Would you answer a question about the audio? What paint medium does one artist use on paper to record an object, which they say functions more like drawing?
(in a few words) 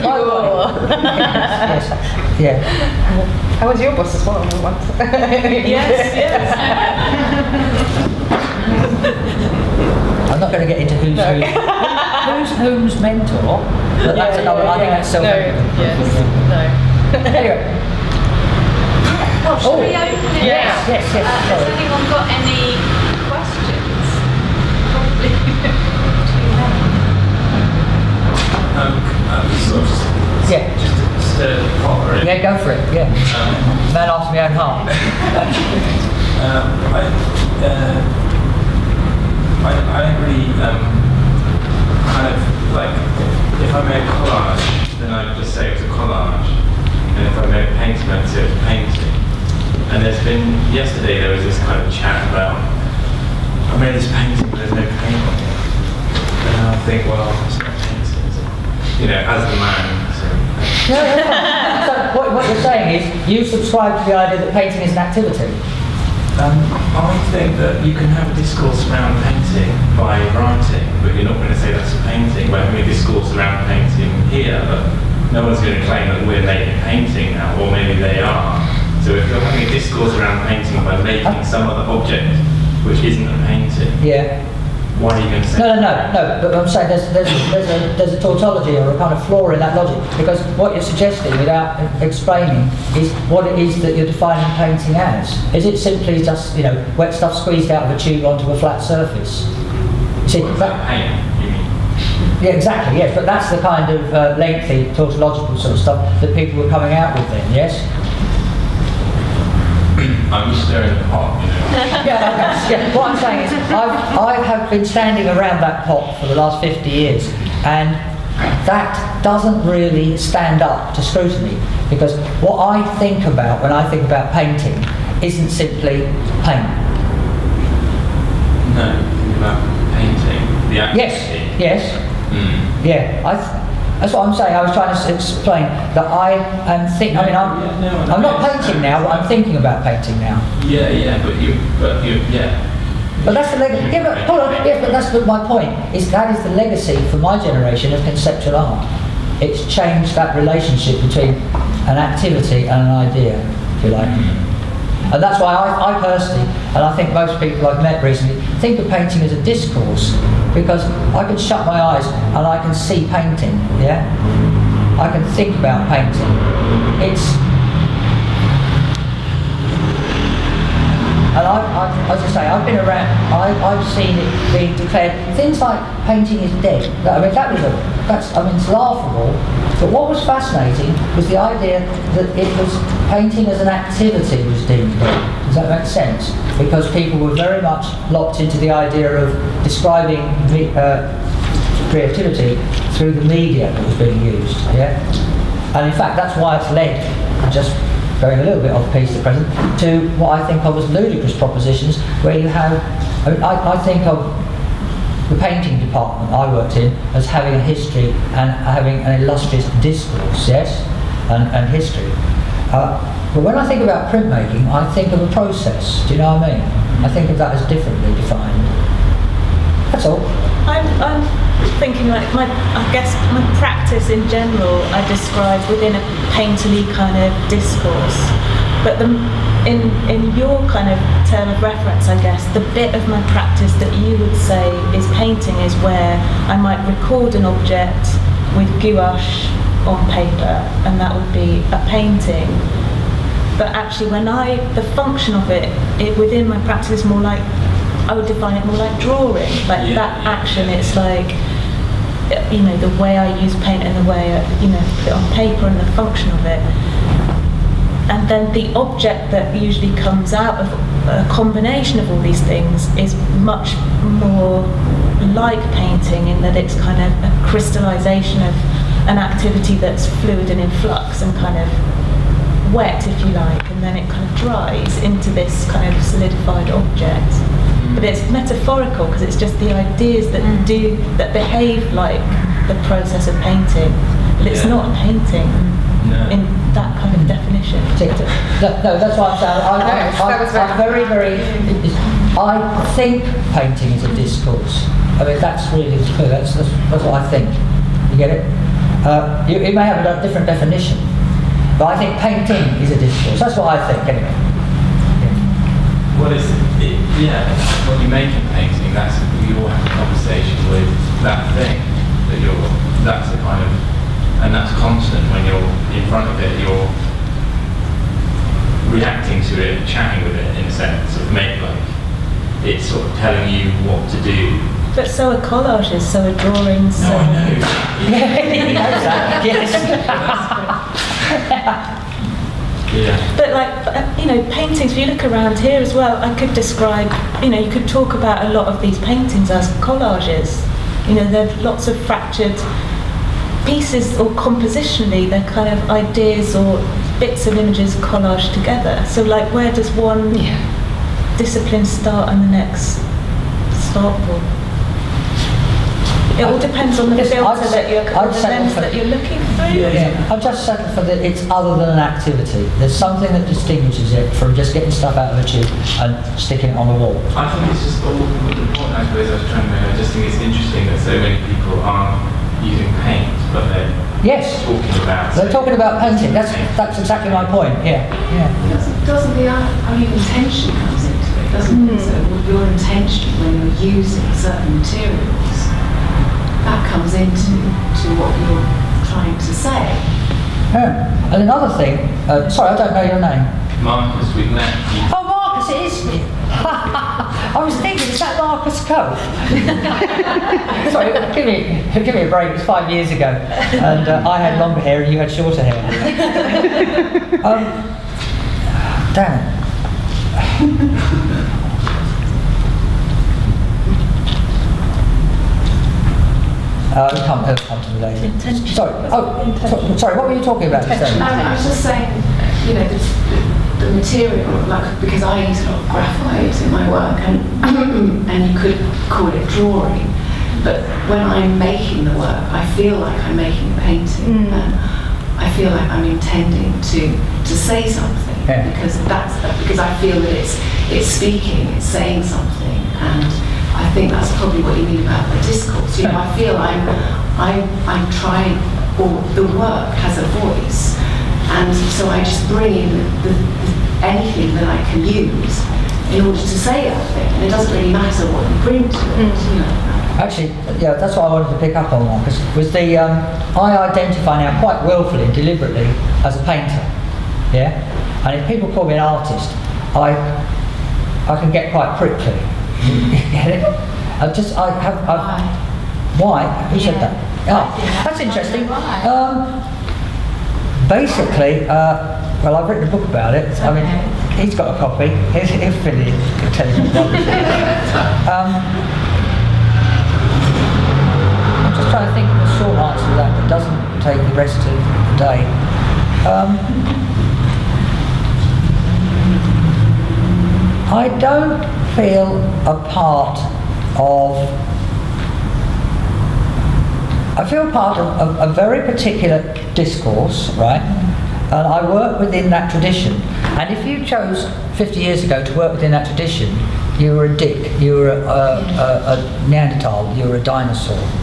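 Gouache.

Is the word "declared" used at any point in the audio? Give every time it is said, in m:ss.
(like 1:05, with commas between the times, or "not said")
2:54.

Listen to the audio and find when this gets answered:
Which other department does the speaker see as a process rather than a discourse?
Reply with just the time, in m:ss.
3:34.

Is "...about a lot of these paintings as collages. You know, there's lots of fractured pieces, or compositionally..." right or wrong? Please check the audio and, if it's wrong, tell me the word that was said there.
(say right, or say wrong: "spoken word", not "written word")
right.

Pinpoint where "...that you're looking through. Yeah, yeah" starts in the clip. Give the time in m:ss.
5:58.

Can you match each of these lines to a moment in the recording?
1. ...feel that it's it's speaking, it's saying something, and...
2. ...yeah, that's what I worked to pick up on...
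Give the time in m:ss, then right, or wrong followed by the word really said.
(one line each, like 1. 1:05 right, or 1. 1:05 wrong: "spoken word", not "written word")
1. 7:19 right
2. 7:40 wrong: "wanted", not "worked".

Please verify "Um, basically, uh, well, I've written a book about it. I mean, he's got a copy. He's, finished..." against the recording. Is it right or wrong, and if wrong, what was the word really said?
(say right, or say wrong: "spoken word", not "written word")
right.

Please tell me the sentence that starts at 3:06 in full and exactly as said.
Because people were very much locked into the idea of describing uh, creativity through the media that was being used.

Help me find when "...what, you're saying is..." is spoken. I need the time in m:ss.
1:02.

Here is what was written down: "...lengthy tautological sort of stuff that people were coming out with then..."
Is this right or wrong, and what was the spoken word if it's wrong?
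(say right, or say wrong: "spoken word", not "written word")
right.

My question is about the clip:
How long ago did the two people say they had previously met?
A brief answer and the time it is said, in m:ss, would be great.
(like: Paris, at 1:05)
5 years, at 6:42.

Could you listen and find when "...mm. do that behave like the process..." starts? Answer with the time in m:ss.
4:40.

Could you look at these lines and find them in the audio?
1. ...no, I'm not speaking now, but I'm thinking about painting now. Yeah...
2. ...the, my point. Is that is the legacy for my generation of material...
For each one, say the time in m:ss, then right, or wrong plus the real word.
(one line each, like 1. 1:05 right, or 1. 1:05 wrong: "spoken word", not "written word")
1. 2:18 wrong: "painting", not "speaking"
2. 2:25 wrong: "conceptual", not "material".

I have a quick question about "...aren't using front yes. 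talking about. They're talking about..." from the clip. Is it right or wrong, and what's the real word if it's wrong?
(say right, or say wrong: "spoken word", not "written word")
wrong: "paint", not "front".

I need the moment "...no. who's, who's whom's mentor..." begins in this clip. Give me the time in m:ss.
0:11.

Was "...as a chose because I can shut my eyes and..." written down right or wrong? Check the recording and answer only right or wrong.
wrong.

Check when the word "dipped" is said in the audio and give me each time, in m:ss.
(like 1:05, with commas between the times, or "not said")
not said.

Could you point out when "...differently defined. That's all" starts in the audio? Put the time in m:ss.
3:37.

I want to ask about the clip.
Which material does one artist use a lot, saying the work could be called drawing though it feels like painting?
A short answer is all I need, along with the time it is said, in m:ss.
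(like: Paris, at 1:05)
Graphite, at 7:05.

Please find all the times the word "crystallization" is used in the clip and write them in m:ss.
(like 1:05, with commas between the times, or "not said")
4:27.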